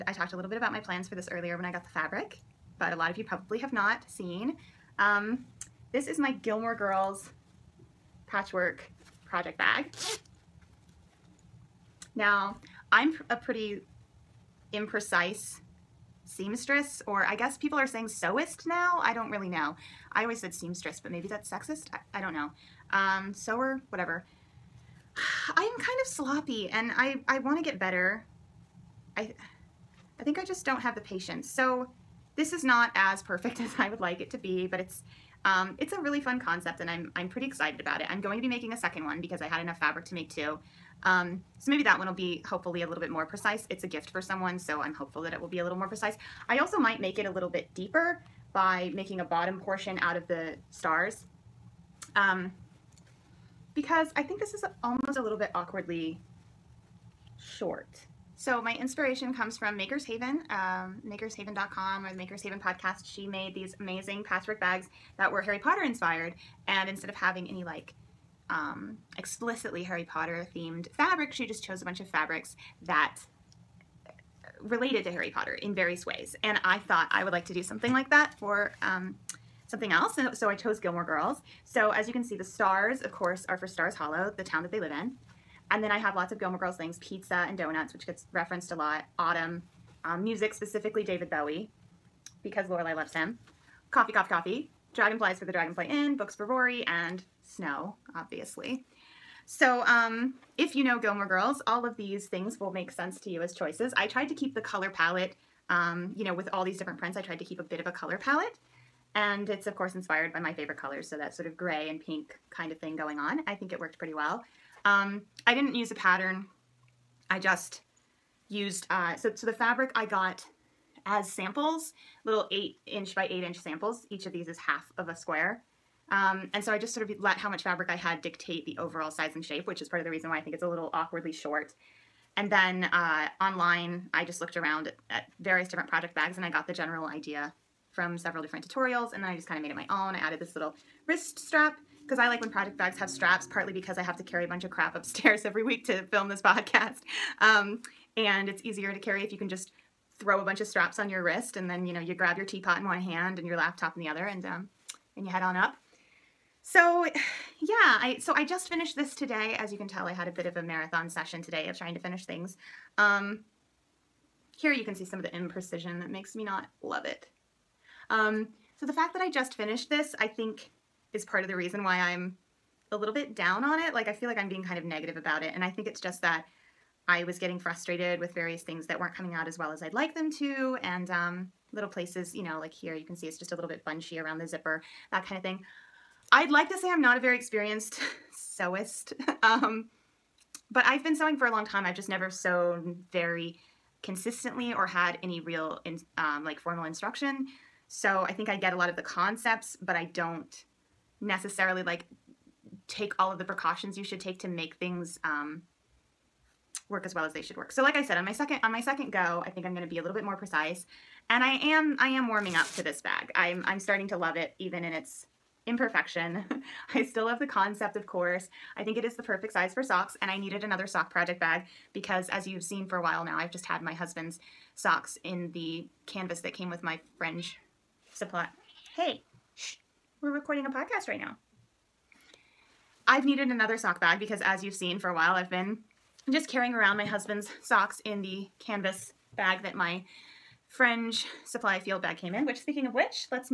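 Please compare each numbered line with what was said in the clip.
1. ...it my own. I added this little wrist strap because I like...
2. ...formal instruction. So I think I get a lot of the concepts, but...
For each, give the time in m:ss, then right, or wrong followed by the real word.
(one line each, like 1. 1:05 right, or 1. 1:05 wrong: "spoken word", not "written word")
1. 2:19 right
2. 3:16 right.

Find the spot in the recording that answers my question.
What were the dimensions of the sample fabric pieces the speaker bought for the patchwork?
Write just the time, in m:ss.
2:02.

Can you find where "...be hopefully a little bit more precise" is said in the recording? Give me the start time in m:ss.
0:42.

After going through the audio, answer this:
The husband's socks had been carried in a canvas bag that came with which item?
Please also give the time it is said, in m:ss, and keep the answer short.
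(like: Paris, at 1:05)
fringe supply field bag, at 4:00.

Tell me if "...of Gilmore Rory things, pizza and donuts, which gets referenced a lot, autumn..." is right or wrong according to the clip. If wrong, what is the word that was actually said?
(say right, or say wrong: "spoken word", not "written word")
wrong: "Girls", not "Rory".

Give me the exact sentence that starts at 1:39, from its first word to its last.
So, um, if you know Gilmore Girls, all of these things will make sense to you as choices.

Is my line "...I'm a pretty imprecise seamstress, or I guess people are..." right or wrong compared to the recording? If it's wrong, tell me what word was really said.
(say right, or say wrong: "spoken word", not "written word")
right.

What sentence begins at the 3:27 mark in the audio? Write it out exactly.
So like I said, on my second on my second go, I think I'm going to be a little bit more precise.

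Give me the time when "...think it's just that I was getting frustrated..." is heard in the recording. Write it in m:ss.
2:55.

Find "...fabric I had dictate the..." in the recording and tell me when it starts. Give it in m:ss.
2:07.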